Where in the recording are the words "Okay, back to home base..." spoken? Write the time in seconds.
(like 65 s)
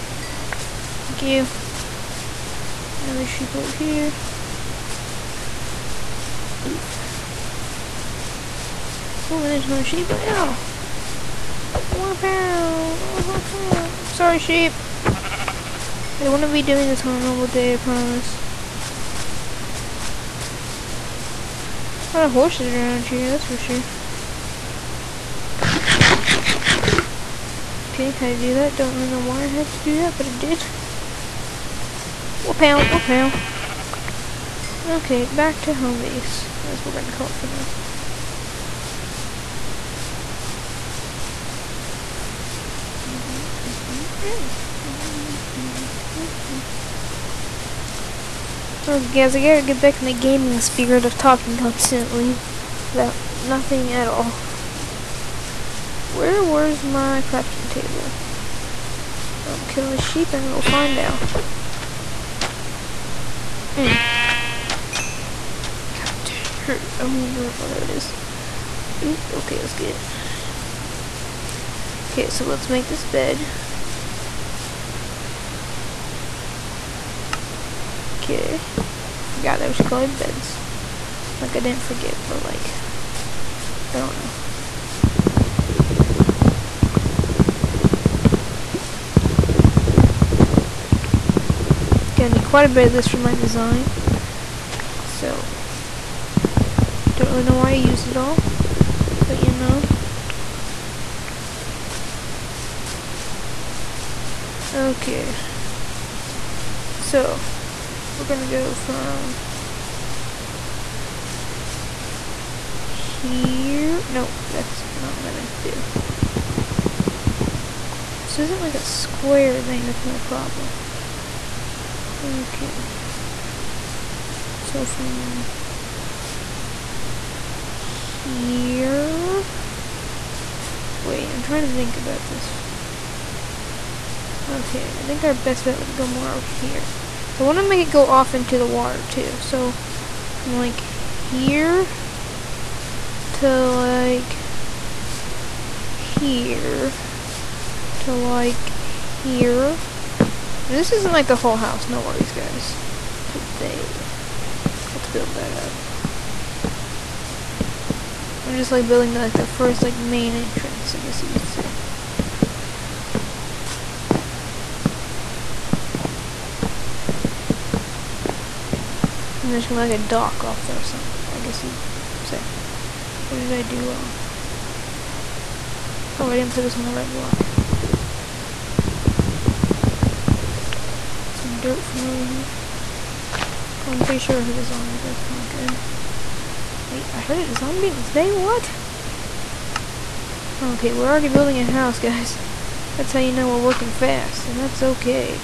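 34 s.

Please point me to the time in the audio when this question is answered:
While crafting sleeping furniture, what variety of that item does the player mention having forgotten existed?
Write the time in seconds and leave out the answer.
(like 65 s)
79 s.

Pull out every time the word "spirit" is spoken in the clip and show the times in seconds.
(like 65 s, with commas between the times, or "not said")
50 s.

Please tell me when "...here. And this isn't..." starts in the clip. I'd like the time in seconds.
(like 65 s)
148 s.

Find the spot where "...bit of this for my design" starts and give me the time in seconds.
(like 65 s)
92 s.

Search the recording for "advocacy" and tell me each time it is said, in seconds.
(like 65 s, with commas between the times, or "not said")
not said.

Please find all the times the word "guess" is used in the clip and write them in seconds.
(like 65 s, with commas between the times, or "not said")
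160 s, 171 s.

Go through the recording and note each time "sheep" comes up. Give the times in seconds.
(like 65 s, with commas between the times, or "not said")
3 s, 9 s, 14 s, 60 s.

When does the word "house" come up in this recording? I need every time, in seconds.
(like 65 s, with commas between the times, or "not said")
151 s, 191 s.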